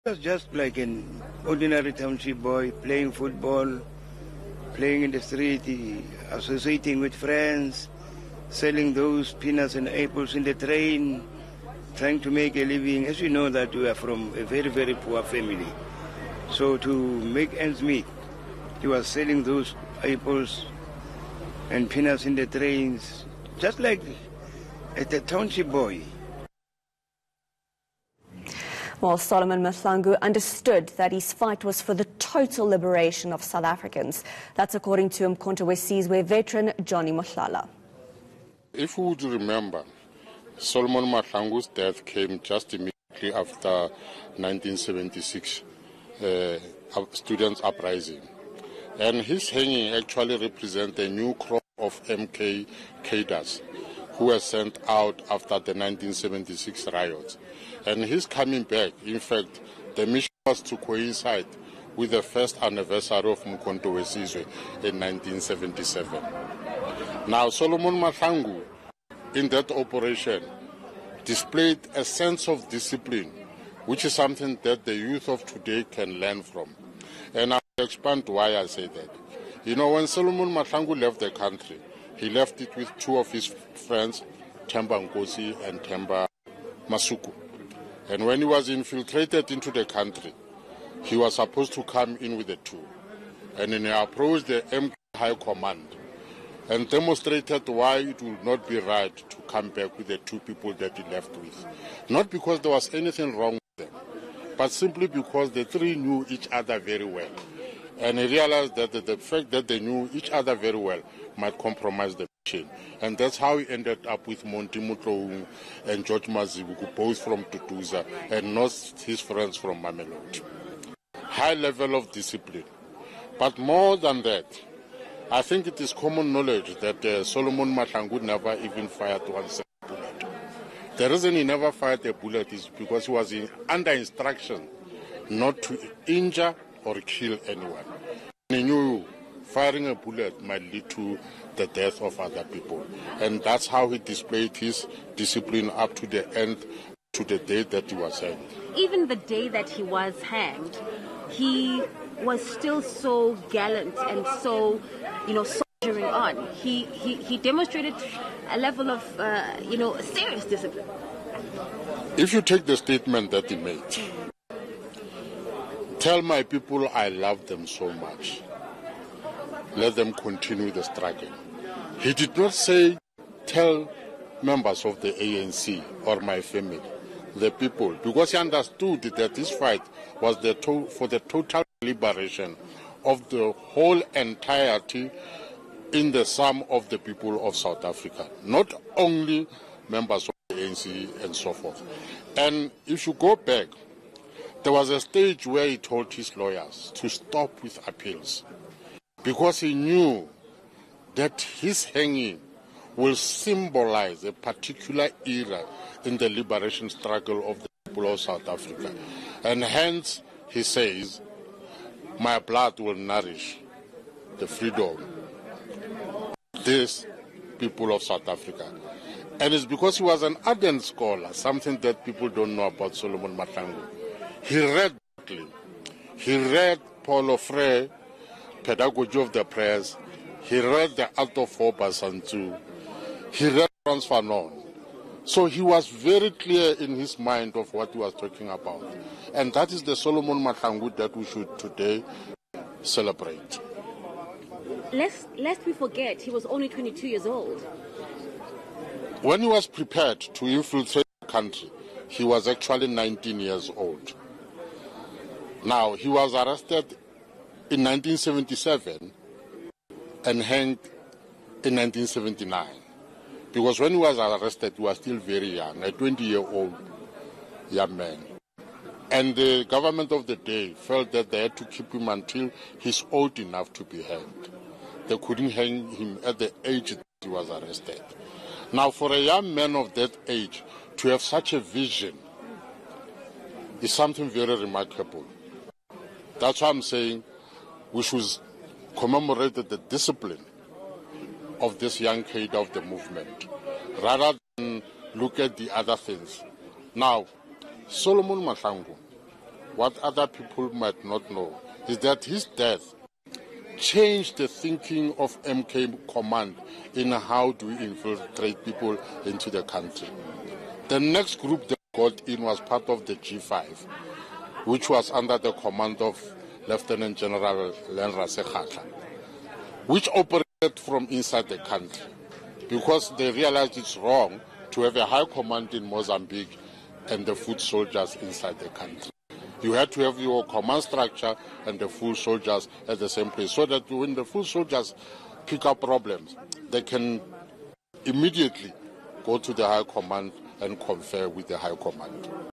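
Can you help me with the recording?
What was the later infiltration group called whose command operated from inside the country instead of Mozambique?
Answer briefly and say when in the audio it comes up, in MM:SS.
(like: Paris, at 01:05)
G5, at 05:13.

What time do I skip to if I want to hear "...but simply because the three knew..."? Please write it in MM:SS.
01:44.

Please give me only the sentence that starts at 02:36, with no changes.
He, he, he demonstrated a level of, uh, you know, serious discipline.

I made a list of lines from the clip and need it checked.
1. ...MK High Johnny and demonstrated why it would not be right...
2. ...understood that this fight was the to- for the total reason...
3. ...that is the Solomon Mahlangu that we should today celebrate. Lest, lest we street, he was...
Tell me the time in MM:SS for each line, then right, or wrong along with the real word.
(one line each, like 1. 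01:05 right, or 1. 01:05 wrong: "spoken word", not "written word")
1. 01:34 wrong: "Command", not "Johnny"
2. 02:58 wrong: "liberation", not "reason"
3. 03:59 wrong: "forget", not "street".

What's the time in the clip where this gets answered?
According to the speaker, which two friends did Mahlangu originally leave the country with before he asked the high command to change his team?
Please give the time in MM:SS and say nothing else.
01:24.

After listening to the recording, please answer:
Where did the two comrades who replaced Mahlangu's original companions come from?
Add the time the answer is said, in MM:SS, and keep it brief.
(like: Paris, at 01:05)
Tutuza, at 01:57.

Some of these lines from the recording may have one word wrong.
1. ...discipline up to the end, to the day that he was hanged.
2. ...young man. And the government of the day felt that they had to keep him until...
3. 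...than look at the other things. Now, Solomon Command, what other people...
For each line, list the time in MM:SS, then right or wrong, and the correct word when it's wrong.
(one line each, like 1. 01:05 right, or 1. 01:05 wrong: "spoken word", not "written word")
1. 02:25 right
2. 04:27 right
3. 04:54 wrong: "Mahlangu", not "Command".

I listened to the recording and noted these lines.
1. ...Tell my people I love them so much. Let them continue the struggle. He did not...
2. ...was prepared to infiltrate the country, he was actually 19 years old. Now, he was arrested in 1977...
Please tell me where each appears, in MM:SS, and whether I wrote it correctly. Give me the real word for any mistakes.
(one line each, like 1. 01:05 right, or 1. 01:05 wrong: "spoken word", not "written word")
1. 02:46 right
2. 04:09 right.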